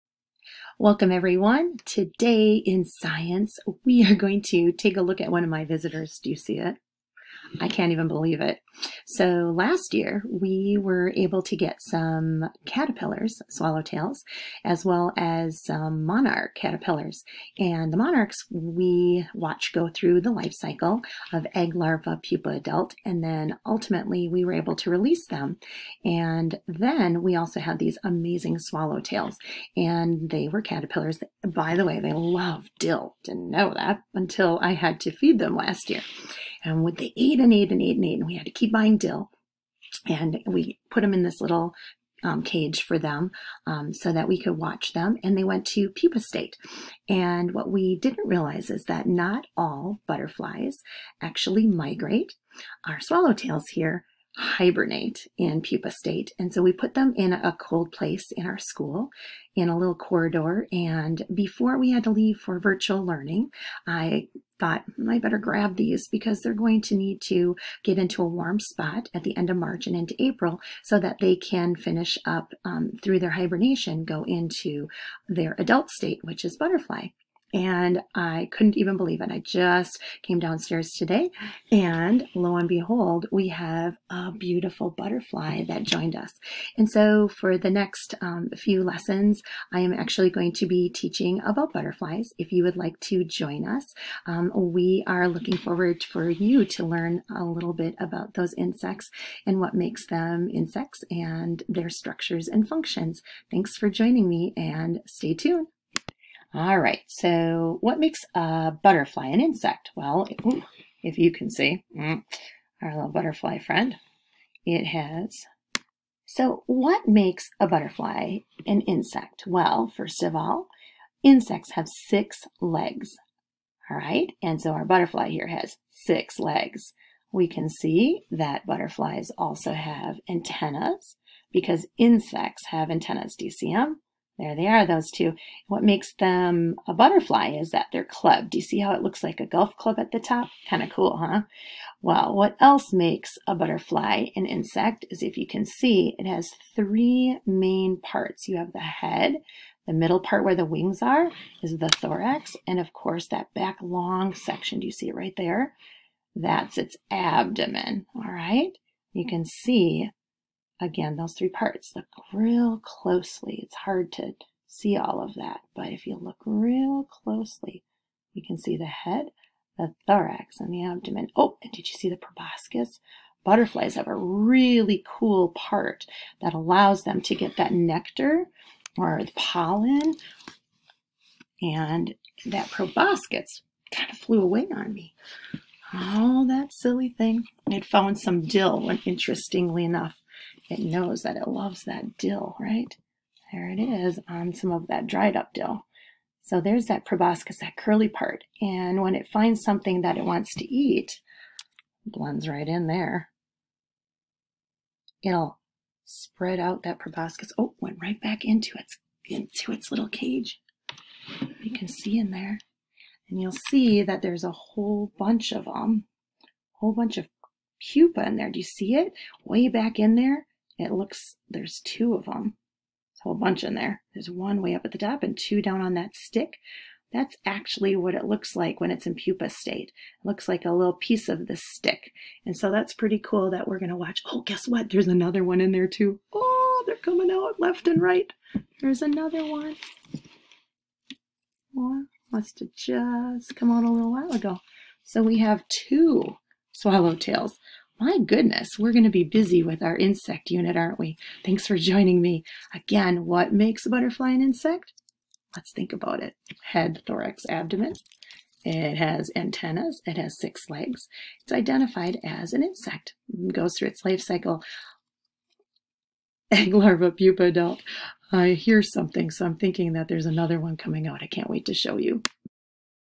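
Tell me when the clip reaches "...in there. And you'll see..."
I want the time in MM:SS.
03:32.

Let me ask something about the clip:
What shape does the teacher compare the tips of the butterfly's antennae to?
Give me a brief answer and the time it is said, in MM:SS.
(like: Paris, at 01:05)
A golf club, at 02:19.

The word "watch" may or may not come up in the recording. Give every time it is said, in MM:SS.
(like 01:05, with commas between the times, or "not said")
00:19, 00:44, 03:53.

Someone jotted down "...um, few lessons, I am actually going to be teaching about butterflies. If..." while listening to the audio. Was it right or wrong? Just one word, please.
right.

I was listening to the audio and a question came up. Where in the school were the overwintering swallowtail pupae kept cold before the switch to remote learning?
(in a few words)
A little corridor.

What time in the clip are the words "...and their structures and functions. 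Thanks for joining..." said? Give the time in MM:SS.
01:41.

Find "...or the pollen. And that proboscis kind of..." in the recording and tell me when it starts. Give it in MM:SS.
02:58.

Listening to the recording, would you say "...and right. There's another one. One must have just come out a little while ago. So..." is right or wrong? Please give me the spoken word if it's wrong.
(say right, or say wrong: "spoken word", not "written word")
right.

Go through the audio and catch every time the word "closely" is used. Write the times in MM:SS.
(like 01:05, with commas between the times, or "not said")
02:42, 02:47.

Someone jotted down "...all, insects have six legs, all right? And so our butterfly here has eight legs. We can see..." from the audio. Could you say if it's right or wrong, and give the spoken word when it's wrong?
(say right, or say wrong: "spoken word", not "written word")
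wrong: "six", not "eight".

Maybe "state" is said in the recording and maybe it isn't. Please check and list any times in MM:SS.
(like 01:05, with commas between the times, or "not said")
00:46, 00:55, 01:15, 03:49.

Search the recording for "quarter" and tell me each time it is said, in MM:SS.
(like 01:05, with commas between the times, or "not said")
not said.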